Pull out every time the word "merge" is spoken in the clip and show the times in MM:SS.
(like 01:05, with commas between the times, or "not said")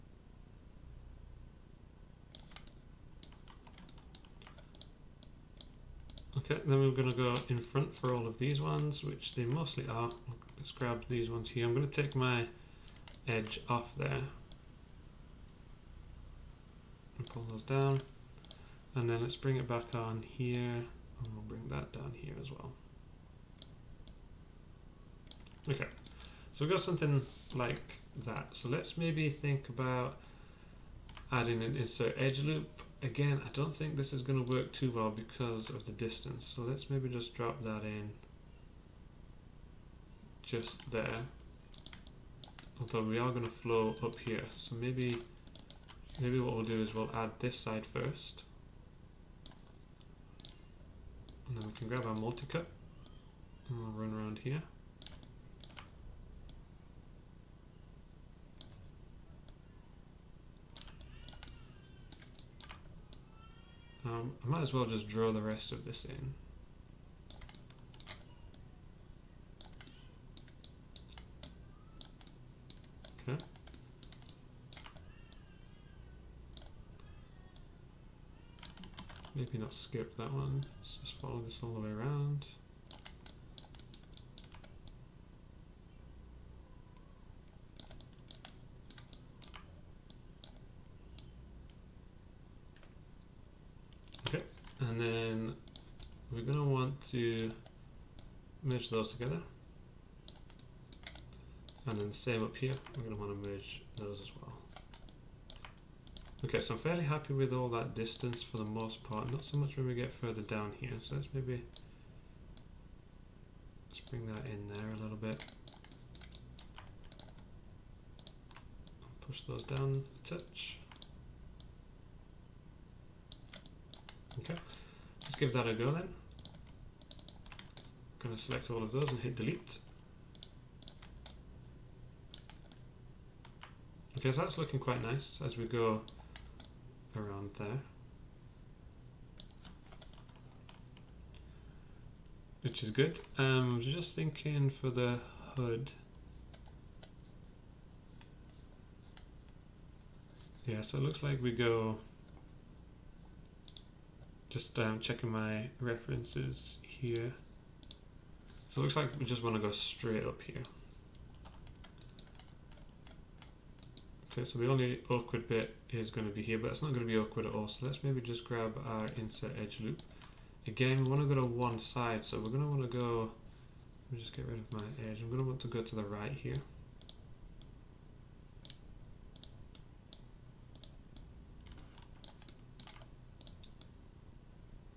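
01:38, 01:43.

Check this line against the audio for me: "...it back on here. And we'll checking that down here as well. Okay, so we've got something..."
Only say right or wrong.
wrong.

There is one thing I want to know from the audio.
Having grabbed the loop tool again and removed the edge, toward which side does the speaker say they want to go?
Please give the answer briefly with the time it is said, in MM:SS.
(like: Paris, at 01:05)
right, at 02:56.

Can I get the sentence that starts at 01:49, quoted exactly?
Not so much when we get further down here, so let's maybe let's bring that in there a little bit.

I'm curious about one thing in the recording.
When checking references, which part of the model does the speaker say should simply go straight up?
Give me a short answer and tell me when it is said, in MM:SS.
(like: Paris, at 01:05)
the hood, at 02:25.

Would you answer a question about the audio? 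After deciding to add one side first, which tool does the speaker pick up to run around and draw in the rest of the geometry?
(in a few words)
multi-cut.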